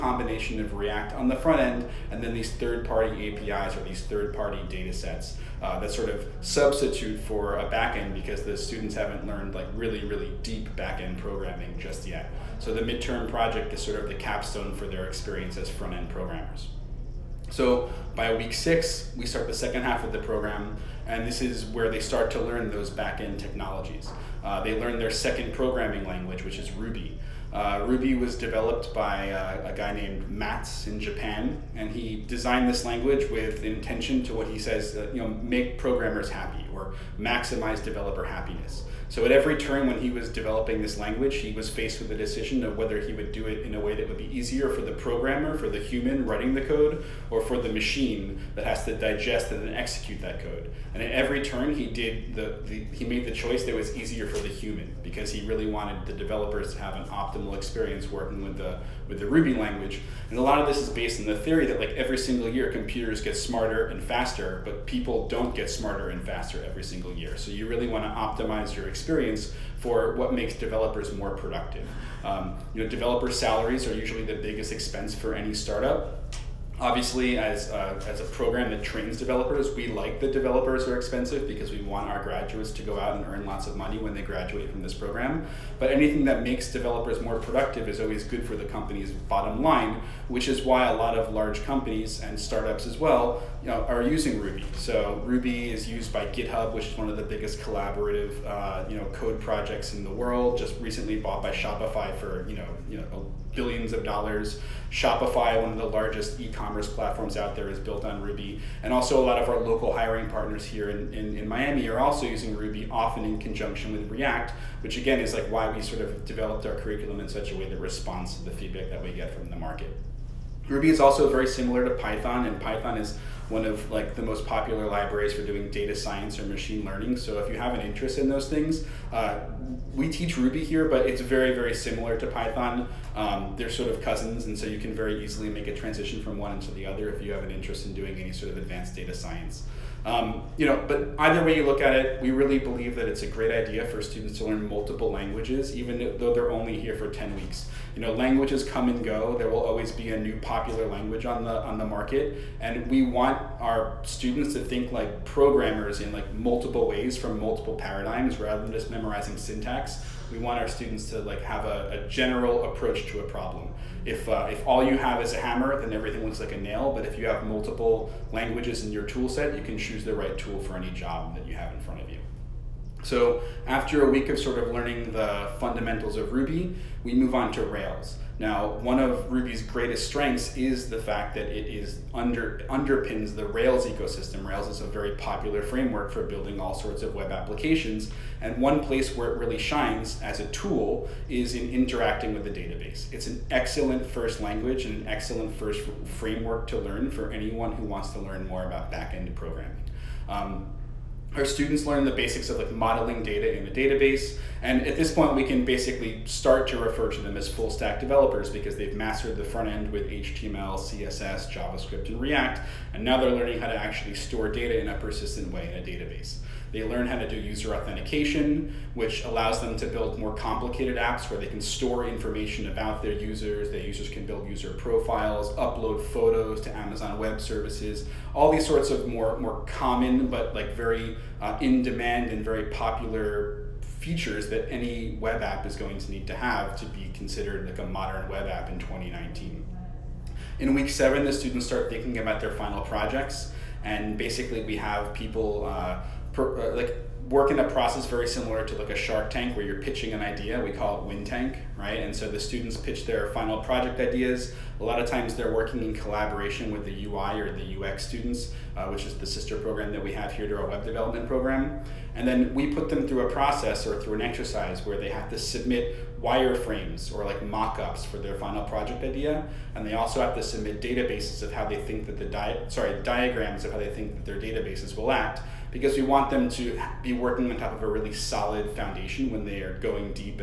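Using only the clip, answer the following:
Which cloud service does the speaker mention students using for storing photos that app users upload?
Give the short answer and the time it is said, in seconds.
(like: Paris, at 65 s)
Amazon Web Services, at 226 s.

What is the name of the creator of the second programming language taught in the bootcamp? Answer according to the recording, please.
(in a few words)
Matz.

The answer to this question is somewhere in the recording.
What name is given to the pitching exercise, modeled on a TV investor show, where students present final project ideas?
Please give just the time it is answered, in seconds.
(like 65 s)
251 s.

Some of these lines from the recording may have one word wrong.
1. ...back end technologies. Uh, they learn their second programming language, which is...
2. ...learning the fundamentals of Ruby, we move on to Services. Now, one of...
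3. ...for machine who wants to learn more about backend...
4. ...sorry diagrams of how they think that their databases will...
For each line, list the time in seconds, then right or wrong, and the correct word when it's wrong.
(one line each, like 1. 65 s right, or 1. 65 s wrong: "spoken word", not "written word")
1. 22 s right
2. 174 s wrong: "Rails", not "Services"
3. 197 s wrong: "anyone", not "machine"
4. 272 s right.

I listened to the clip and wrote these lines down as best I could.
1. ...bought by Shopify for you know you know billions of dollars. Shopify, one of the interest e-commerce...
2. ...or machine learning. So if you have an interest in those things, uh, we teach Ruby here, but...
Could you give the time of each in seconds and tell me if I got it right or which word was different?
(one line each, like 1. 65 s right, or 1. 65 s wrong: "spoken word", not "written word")
1. 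101 s wrong: "largest", not "interest"
2. 126 s right.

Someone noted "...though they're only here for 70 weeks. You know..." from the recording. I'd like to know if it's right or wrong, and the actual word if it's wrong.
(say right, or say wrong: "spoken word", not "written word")
wrong: "10", not "70".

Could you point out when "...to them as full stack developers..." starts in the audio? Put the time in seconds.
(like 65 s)
207 s.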